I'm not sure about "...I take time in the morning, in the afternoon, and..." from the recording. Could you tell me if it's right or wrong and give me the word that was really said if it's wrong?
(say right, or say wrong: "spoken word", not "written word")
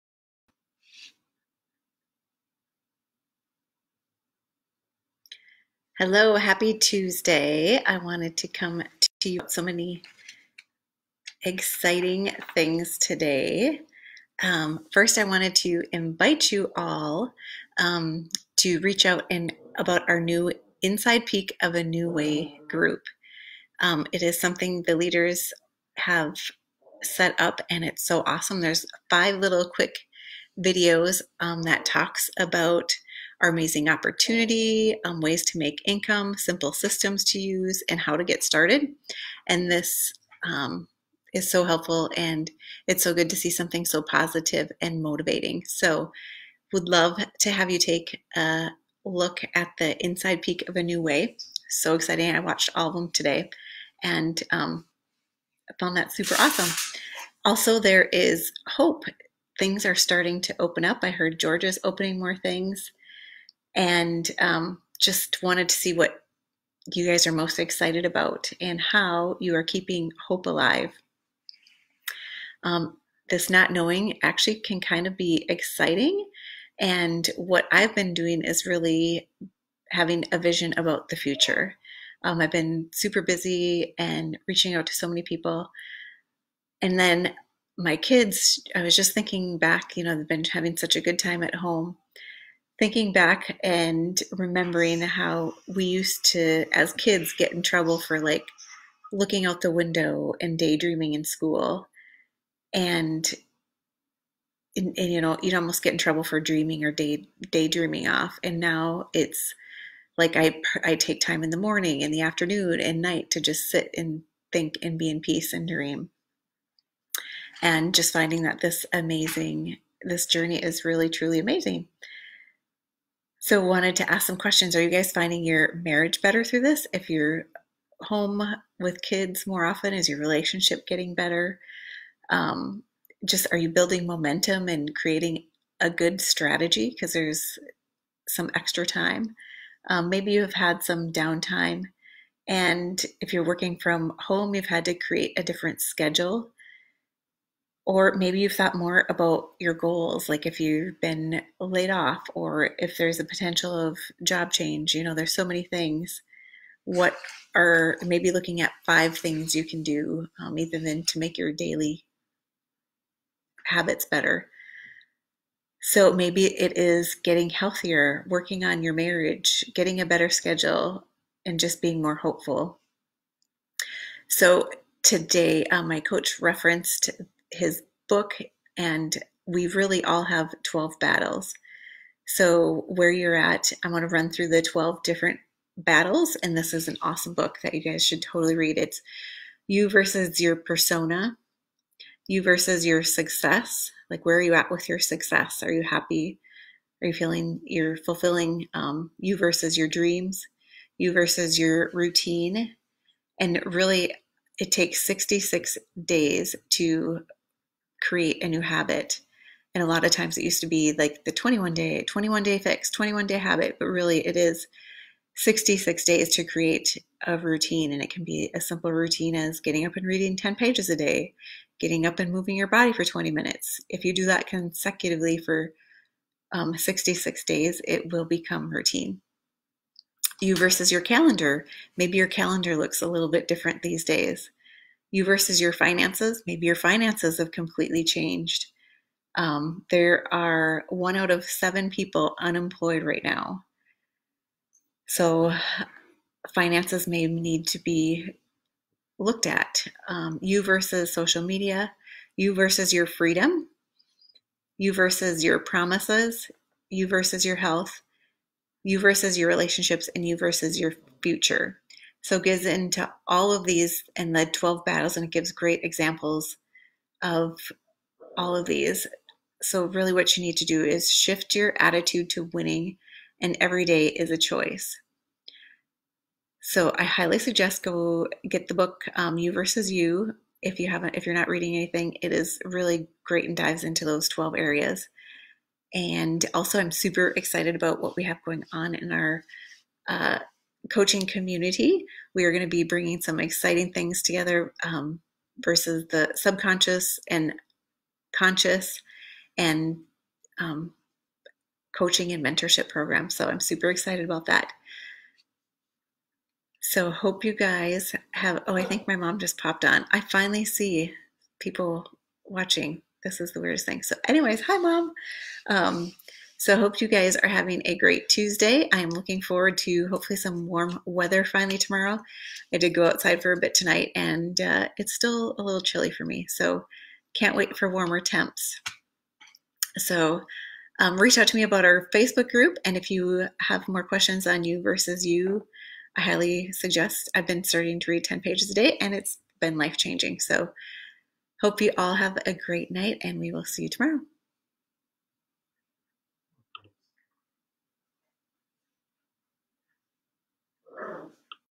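right.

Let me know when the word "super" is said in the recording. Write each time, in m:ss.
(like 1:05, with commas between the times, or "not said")
0:56, 1:22, 4:46, 5:03.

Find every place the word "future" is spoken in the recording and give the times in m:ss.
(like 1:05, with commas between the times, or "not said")
1:21, 4:21.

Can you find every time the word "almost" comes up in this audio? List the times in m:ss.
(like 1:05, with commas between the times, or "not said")
1:45.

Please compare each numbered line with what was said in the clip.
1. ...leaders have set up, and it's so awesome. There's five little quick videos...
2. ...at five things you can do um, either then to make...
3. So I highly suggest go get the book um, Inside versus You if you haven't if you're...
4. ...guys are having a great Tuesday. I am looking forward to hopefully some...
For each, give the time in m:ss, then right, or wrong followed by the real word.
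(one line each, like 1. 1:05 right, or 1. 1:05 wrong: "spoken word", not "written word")
1. 0:24 right
2. 2:38 right
3. 4:36 wrong: "You", not "Inside"
4. 5:17 right.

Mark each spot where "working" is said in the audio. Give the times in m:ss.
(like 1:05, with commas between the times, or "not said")
2:23, 2:48.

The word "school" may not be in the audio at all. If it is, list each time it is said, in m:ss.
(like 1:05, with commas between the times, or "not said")
1:41.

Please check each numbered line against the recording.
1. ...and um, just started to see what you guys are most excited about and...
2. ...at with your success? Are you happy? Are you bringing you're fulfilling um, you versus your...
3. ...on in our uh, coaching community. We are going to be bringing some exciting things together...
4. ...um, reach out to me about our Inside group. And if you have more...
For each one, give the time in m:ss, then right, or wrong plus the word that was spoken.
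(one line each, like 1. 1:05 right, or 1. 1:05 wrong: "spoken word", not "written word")
1. 1:03 wrong: "wanted", not "started"
2. 3:14 wrong: "feeling", not "bringing"
3. 4:48 right
4. 5:30 wrong: "Facebook", not "Inside".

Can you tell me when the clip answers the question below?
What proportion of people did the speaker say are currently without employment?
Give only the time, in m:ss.
4:00.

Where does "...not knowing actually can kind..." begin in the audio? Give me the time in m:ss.
1:13.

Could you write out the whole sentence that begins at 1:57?
And just finding that this amazing, this journey is really, truly amazing.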